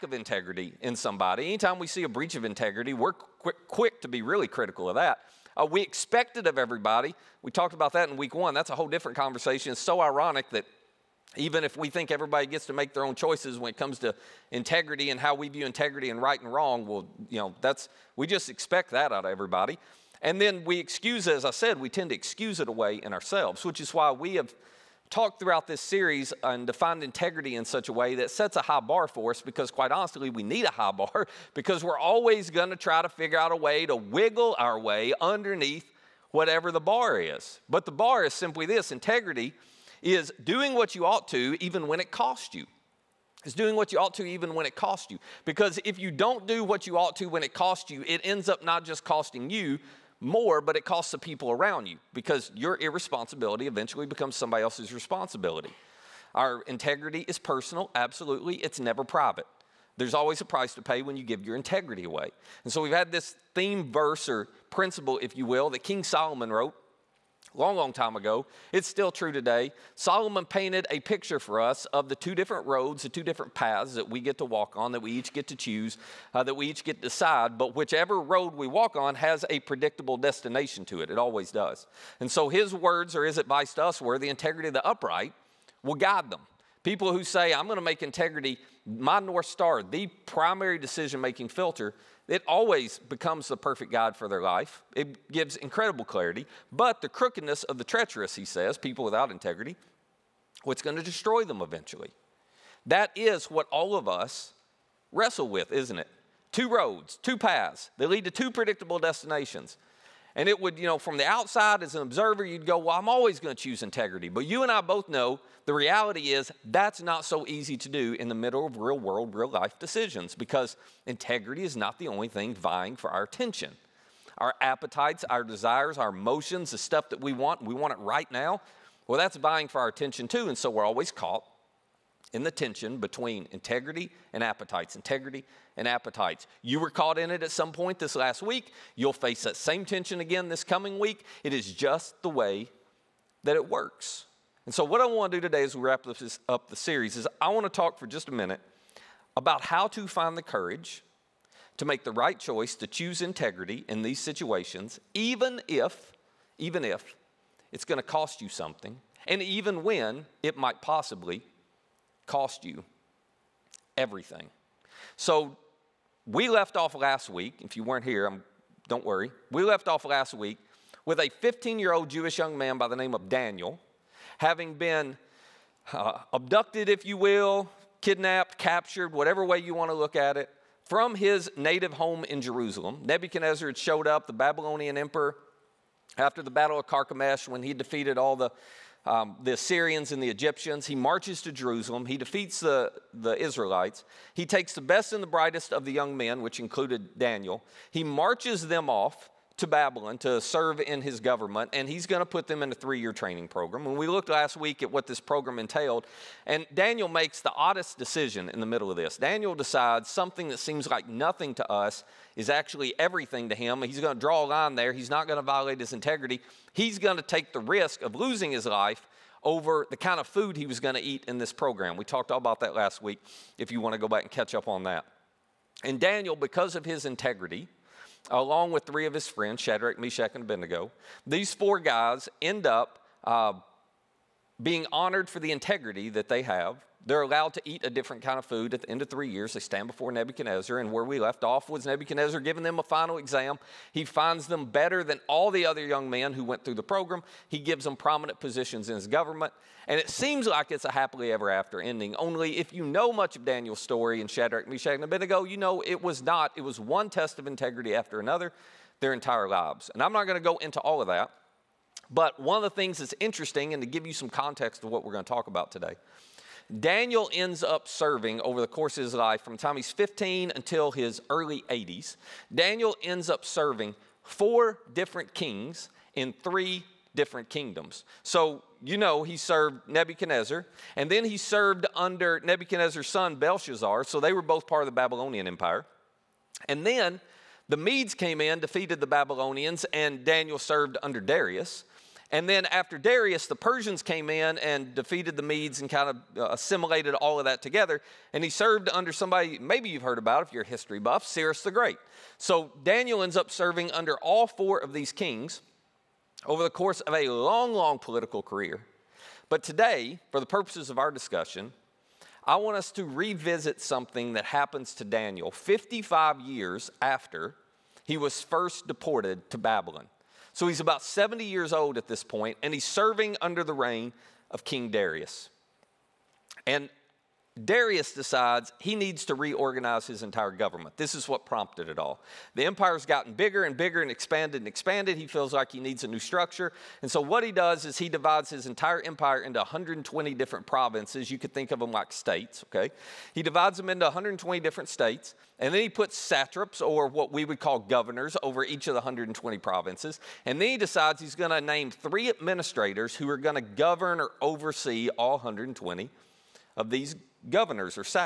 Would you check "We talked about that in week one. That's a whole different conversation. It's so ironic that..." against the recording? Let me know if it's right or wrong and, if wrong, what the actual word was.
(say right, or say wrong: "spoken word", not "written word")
right.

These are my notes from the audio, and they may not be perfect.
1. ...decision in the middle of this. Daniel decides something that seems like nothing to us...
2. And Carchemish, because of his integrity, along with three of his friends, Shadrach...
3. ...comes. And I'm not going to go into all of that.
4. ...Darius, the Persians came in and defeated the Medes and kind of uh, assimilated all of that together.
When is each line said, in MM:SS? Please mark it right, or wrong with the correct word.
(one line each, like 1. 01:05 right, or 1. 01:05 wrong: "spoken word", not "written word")
1. 03:27 right
2. 03:45 wrong: "Daniel", not "Carchemish"
3. 04:19 wrong: "lives", not "comes"
4. 04:52 right.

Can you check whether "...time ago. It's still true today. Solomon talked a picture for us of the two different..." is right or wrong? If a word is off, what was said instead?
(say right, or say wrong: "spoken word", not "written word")
wrong: "painted", not "talked".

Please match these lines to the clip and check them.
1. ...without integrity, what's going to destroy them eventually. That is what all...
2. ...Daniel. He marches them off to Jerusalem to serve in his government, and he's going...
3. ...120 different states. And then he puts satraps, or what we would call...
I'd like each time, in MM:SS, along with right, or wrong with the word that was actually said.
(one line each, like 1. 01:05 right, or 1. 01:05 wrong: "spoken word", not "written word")
1. 01:39 right
2. 03:17 wrong: "Babylon", not "Jerusalem"
3. 05:44 right.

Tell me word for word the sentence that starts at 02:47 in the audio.
If you weren't here, I'm, don't worry.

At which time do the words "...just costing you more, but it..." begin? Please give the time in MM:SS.
00:48.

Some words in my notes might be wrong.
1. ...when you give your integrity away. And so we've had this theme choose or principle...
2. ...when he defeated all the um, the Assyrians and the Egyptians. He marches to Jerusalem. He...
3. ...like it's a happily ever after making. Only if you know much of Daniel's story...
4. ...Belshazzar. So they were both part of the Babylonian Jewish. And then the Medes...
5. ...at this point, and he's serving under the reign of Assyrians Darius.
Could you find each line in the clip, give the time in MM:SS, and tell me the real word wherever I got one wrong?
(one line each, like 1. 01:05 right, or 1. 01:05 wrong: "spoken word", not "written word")
1. 01:01 wrong: "verse", not "choose"
2. 03:07 right
3. 04:10 wrong: "ending", not "making"
4. 04:43 wrong: "Empire", not "Jewish"
5. 05:21 wrong: "King", not "Assyrians".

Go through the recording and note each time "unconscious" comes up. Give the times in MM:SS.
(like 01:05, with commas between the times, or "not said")
not said.